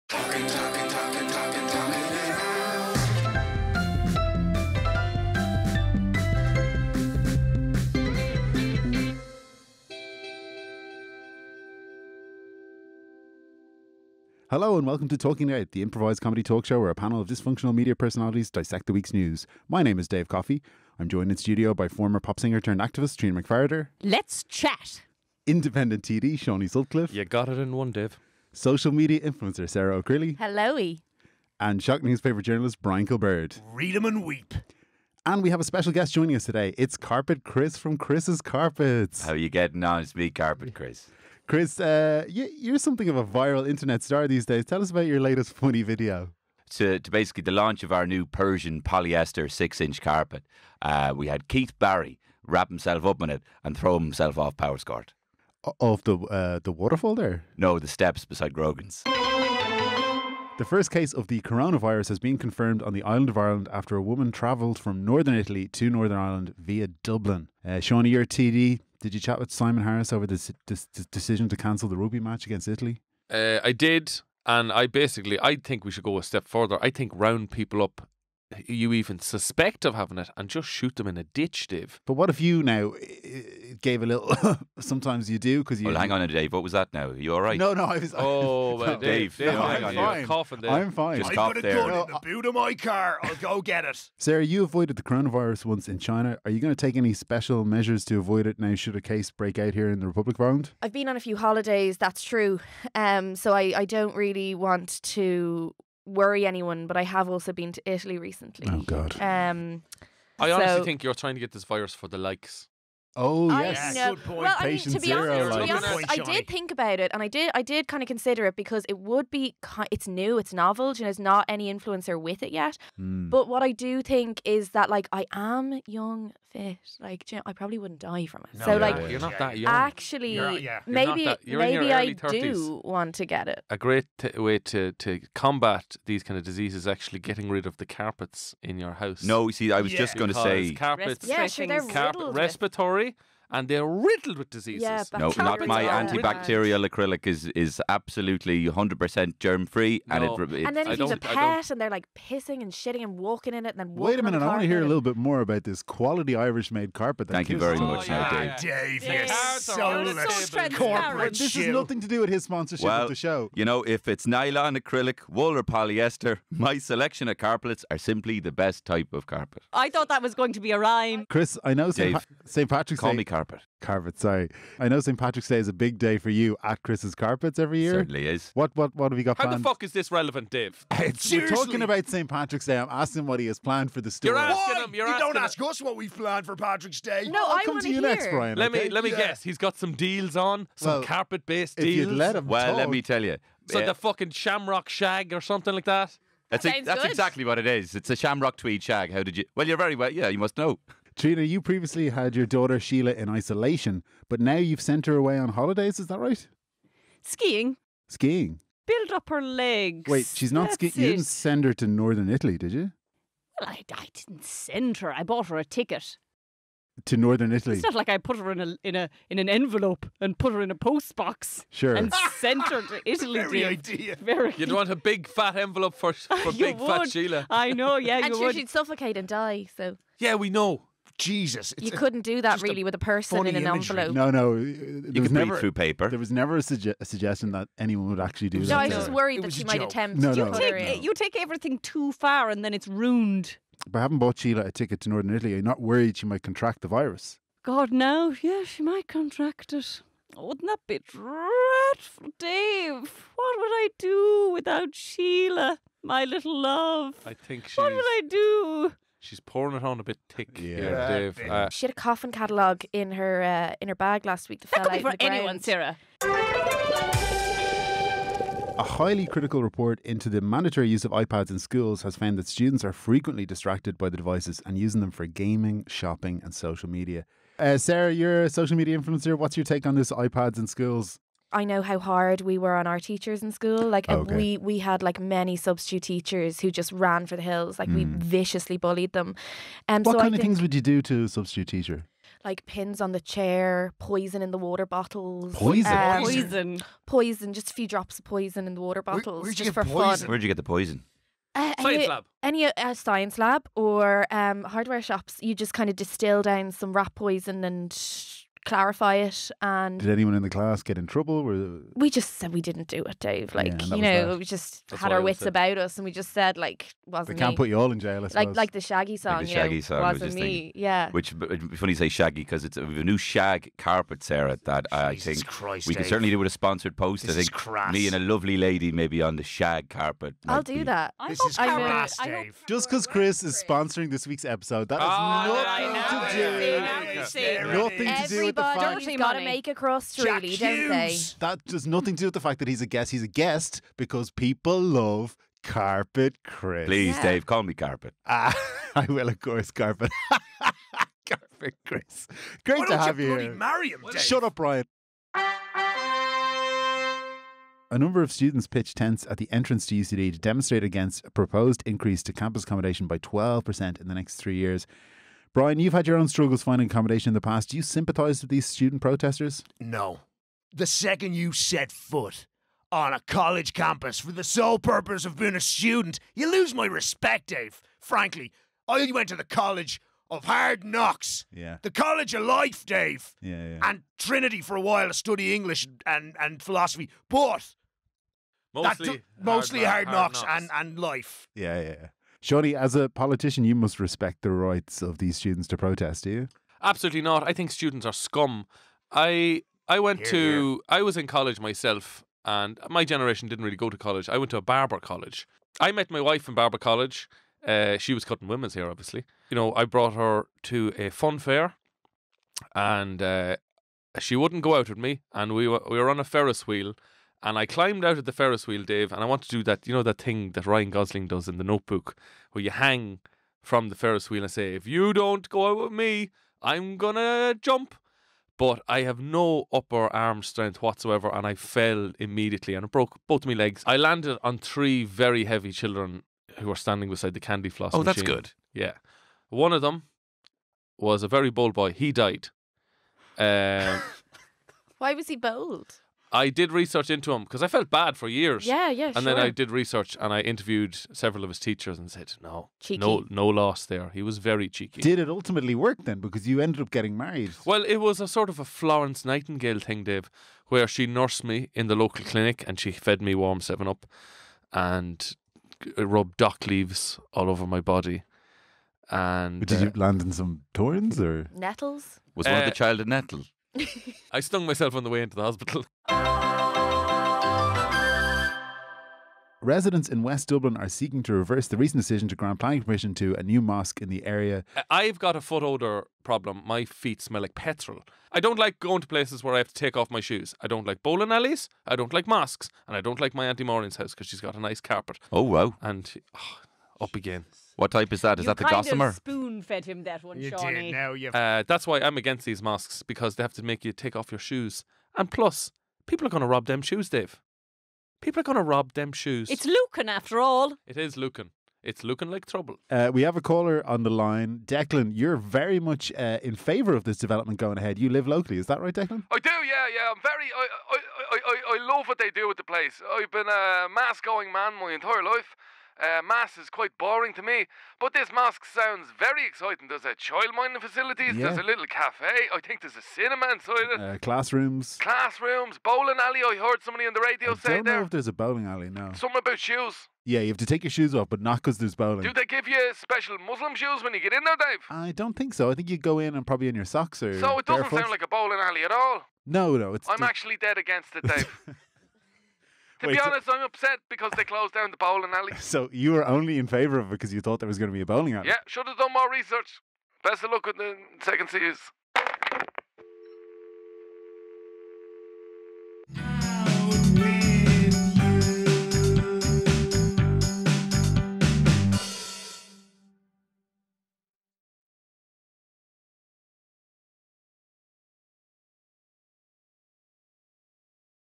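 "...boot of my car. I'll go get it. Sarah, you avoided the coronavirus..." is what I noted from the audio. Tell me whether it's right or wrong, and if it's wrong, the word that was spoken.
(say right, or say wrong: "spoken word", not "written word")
right.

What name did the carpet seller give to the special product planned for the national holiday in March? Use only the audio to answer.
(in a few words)
Shamrock tweed shag.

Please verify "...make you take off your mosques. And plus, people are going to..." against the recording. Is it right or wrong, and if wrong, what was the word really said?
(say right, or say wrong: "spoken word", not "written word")
wrong: "shoes", not "mosques".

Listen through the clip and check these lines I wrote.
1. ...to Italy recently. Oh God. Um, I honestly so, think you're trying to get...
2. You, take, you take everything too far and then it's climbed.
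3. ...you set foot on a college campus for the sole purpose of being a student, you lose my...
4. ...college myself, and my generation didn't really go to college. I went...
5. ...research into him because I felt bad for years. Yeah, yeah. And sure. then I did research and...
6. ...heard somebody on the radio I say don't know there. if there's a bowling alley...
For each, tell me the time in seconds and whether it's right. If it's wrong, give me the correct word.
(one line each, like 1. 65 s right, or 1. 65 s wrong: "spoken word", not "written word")
1. 107 s right
2. 240 s wrong: "ruined", not "climbed"
3. 371 s right
4. 401 s right
5. 446 s right
6. 536 s right.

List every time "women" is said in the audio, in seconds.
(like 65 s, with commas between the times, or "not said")
408 s.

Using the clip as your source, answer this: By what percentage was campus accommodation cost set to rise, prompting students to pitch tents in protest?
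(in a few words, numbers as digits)
12%.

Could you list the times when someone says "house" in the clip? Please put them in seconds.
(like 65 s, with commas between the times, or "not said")
138 s, 493 s.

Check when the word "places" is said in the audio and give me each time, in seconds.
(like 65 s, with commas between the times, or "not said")
489 s, 522 s.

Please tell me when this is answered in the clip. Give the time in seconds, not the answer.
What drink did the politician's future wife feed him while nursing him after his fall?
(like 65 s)
463 s.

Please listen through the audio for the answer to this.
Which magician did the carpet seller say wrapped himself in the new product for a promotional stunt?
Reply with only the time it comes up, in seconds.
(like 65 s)
51 s.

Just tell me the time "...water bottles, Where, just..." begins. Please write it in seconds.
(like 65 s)
298 s.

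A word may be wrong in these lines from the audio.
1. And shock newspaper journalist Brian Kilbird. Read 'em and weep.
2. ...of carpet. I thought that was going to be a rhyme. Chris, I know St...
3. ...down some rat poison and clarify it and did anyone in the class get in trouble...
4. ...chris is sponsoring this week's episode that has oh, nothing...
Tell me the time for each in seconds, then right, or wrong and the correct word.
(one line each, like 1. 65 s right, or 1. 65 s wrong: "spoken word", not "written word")
1. 31 s right
2. 169 s right
3. 306 s right
4. 333 s right.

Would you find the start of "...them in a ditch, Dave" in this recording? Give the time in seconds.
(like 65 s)
80 s.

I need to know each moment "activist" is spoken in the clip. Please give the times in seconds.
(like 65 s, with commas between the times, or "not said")
22 s.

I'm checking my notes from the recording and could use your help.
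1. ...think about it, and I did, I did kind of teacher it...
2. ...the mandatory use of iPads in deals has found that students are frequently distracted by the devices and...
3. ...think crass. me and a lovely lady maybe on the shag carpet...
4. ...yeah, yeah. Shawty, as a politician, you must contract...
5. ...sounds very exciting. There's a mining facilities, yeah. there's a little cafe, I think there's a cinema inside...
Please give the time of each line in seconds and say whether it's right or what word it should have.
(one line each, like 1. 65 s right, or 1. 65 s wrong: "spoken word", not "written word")
1. 116 s wrong: "consider", not "teacher"
2. 270 s wrong: "schools", not "deals"
3. 327 s right
4. 391 s wrong: "respect", not "contract"
5. 528 s right.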